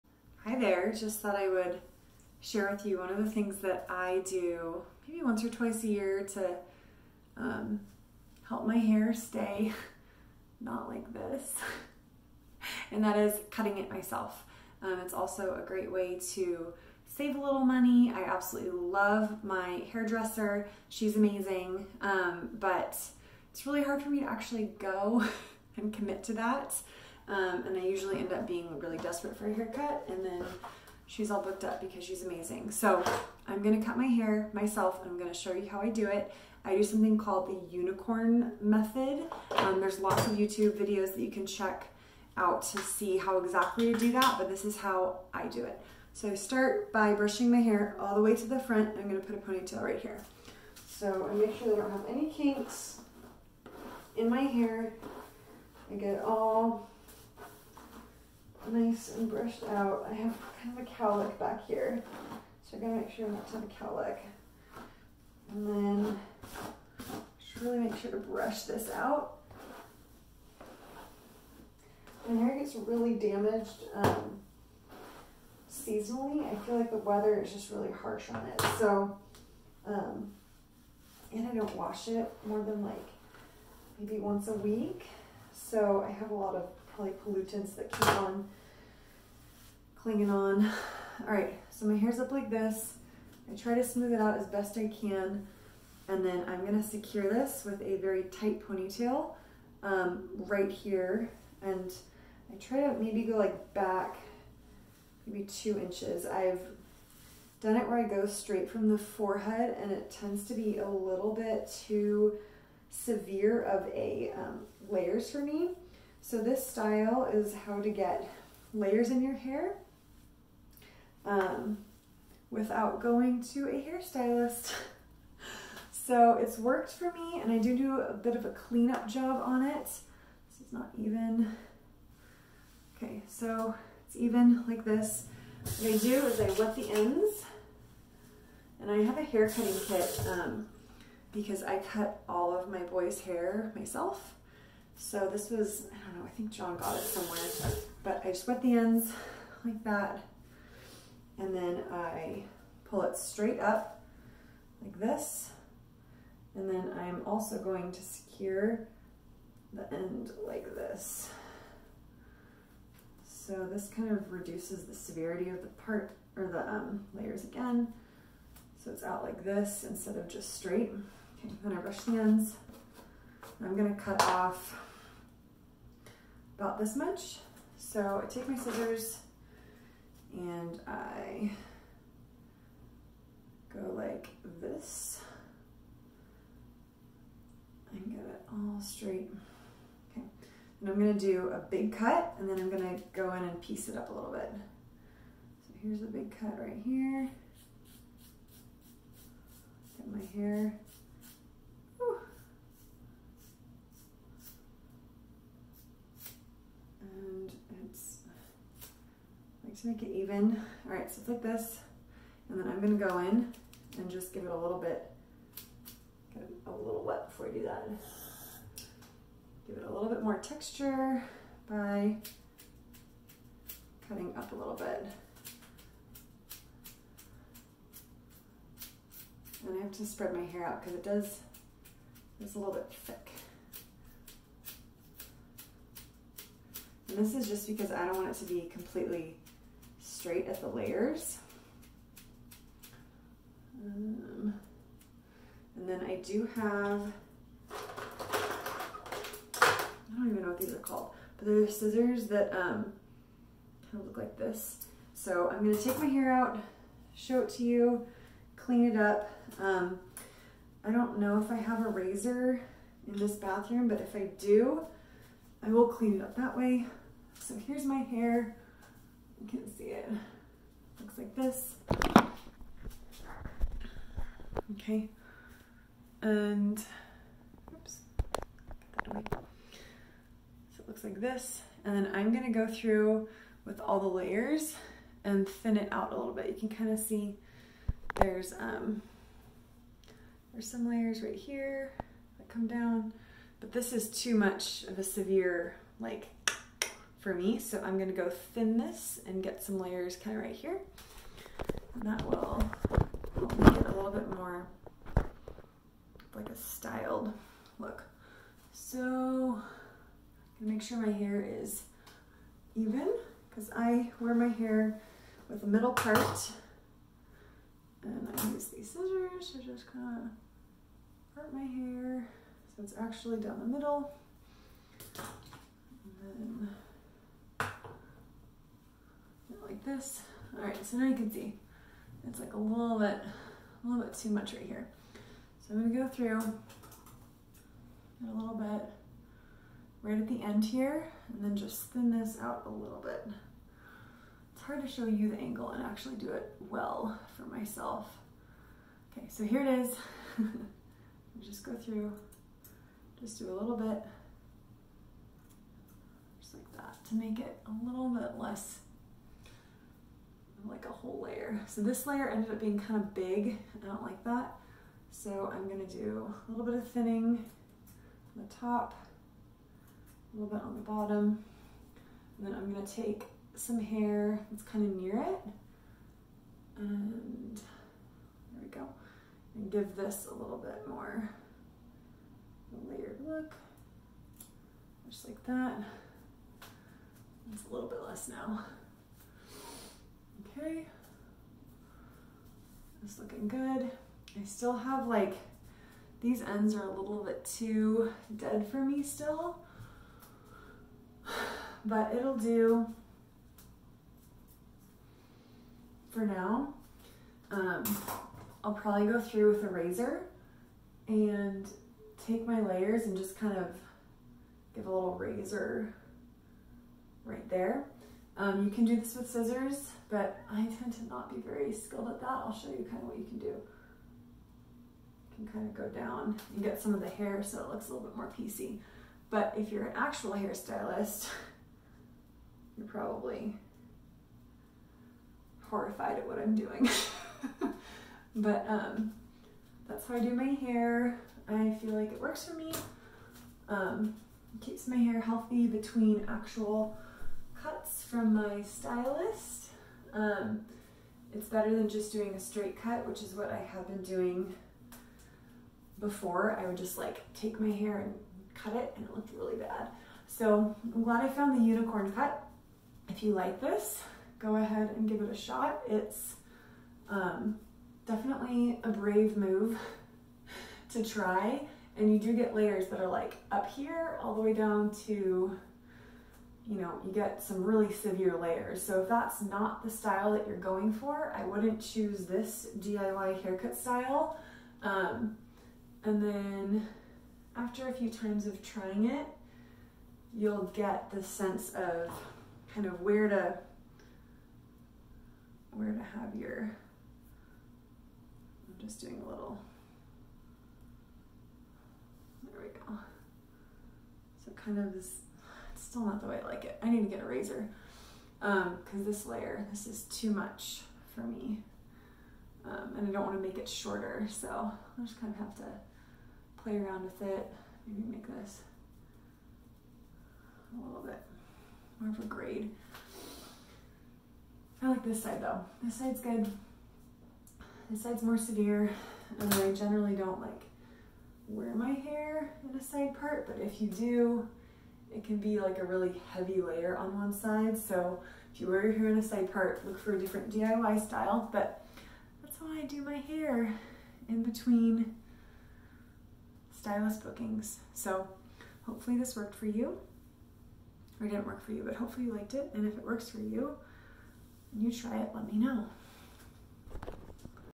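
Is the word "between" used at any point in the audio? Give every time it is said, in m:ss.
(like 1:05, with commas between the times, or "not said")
7:25, 9:04.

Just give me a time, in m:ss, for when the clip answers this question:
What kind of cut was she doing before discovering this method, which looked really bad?
7:32.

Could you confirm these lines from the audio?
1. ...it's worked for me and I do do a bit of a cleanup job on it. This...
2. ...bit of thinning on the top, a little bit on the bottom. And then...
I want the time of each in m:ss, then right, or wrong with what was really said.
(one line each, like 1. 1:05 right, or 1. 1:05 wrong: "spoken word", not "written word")
1. 2:06 right
2. 6:06 right.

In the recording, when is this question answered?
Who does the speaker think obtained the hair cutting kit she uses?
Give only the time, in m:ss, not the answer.
2:26.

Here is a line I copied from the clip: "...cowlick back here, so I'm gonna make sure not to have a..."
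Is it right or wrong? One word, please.
right.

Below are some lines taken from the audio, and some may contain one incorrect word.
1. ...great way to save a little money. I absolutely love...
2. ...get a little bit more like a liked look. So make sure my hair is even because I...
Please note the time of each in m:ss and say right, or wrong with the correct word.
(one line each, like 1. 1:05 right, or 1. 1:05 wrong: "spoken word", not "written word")
1. 0:15 right
2. 5:03 wrong: "styled", not "liked".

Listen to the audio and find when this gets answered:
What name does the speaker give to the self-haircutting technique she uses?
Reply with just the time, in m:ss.
0:37.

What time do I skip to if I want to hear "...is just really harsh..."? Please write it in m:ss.
1:17.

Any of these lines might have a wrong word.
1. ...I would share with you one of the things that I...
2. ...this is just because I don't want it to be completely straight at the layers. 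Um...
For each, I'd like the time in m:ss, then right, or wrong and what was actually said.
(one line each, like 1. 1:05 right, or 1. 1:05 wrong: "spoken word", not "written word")
1. 0:01 right
2. 3:57 right.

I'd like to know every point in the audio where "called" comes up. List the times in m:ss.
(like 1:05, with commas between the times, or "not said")
0:37, 4:10.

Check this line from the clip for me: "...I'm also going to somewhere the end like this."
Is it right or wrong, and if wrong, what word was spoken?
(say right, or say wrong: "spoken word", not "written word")
wrong: "secure", not "somewhere".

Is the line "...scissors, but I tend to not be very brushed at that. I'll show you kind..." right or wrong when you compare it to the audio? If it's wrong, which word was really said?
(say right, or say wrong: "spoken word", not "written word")
wrong: "skilled", not "brushed".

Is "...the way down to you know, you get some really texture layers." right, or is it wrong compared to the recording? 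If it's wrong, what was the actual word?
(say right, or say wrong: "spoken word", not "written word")
wrong: "severe", not "texture".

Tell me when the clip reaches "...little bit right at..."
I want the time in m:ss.
5:38.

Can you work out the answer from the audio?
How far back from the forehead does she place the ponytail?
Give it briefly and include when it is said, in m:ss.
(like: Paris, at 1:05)
2 inches, at 1:45.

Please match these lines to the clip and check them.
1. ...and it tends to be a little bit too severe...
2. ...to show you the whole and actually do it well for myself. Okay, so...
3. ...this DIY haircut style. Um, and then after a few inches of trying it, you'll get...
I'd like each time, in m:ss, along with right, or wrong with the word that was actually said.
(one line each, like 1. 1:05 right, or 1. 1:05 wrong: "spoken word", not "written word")
1. 1:49 right
2. 5:44 wrong: "angle", not "whole"
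3. 8:02 wrong: "times", not "inches".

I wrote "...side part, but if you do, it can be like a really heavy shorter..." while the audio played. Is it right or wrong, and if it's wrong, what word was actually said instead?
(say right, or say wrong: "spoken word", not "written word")
wrong: "layer", not "shorter".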